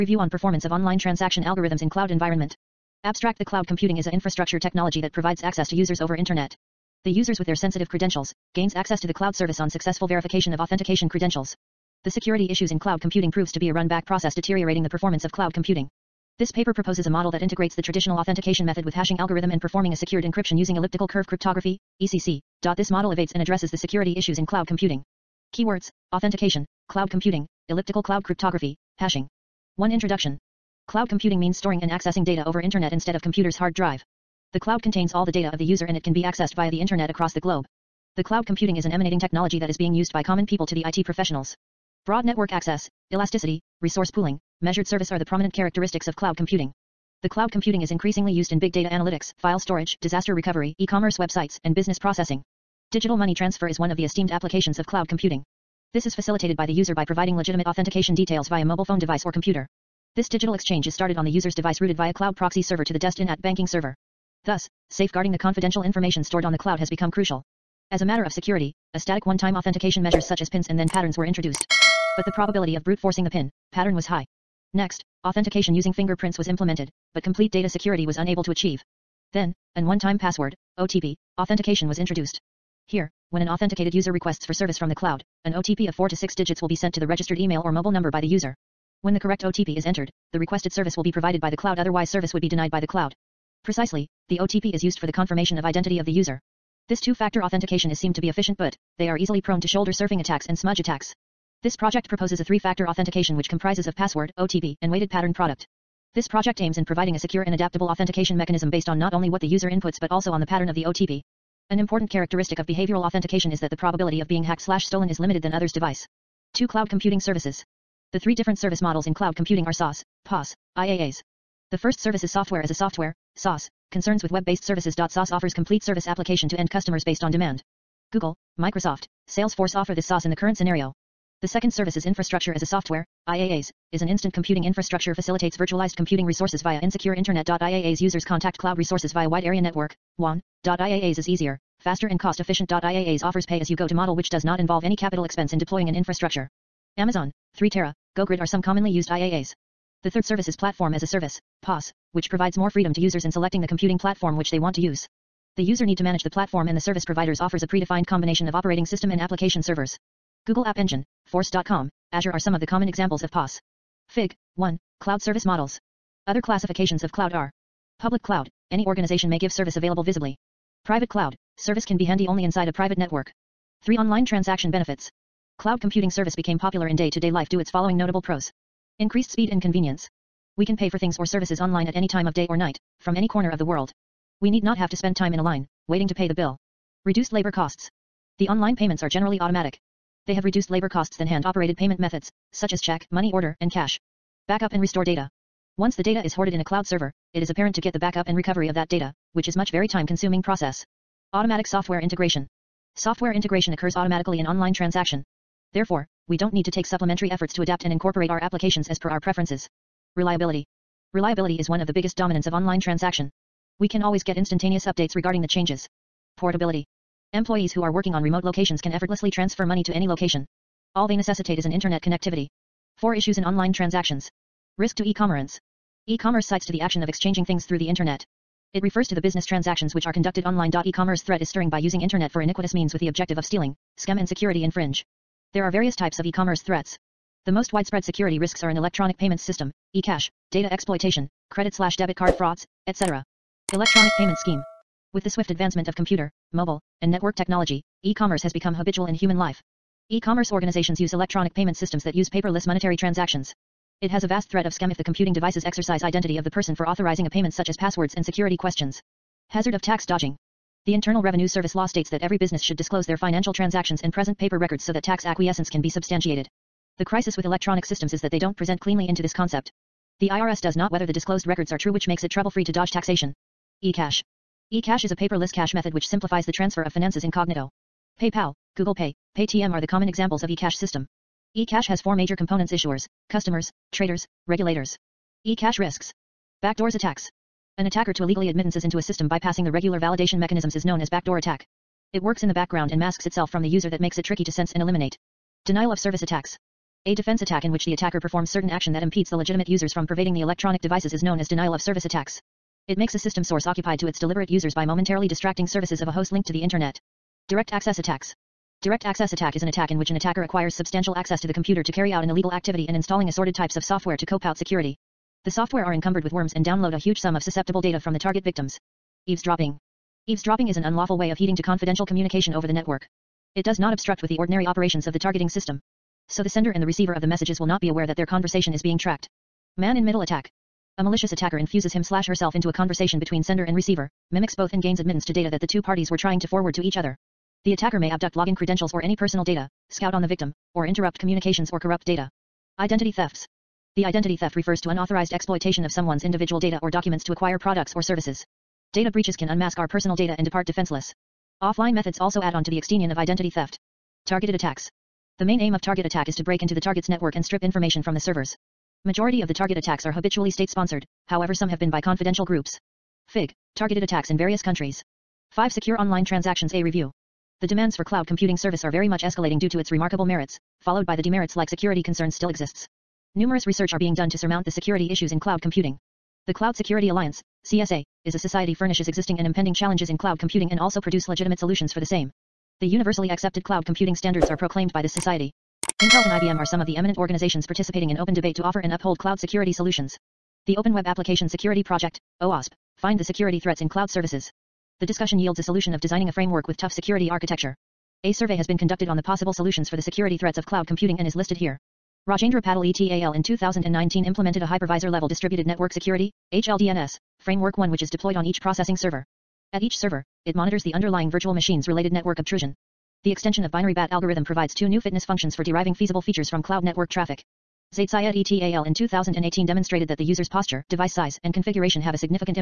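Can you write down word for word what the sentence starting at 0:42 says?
Broad network access, elasticity, resource pooling, measured service are the prominent characteristics of cloud computing.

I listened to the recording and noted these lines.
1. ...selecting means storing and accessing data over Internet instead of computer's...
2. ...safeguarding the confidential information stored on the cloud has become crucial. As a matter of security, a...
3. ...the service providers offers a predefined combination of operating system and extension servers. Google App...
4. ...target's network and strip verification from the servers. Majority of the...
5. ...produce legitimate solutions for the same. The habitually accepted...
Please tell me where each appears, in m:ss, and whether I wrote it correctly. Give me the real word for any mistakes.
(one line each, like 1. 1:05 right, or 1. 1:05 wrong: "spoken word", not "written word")
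1. 0:31 wrong: "computing", not "selecting"
2. 1:04 right
3. 2:36 wrong: "application", not "extension"
4. 5:56 wrong: "information", not "verification"
5. 6:21 wrong: "universally", not "habitually".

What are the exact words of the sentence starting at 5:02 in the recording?
It makes a system source occupied to its deliberate users by momentarily distracting services of a host linked to the Internet.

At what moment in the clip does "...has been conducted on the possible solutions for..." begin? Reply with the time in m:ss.
6:38.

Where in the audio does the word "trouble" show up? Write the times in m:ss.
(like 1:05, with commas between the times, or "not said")
4:32.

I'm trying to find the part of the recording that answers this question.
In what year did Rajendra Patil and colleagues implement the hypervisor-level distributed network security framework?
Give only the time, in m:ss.
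6:43.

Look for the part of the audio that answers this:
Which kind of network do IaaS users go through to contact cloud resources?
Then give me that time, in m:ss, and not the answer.
2:19.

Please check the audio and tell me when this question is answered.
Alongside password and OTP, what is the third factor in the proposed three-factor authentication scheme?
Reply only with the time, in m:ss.
1:44.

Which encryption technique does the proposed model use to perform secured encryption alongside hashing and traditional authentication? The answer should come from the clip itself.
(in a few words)
elliptical curve cryptography.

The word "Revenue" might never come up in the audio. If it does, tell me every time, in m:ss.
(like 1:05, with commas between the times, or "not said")
4:21.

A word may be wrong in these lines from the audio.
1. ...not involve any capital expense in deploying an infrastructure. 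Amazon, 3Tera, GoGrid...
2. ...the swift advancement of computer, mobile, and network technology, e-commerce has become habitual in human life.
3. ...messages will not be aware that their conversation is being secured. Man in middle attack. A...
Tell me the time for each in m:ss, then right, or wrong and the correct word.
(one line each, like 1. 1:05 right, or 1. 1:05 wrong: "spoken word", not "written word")
1. 2:24 right
2. 4:05 right
3. 5:27 wrong: "tracked", not "secured".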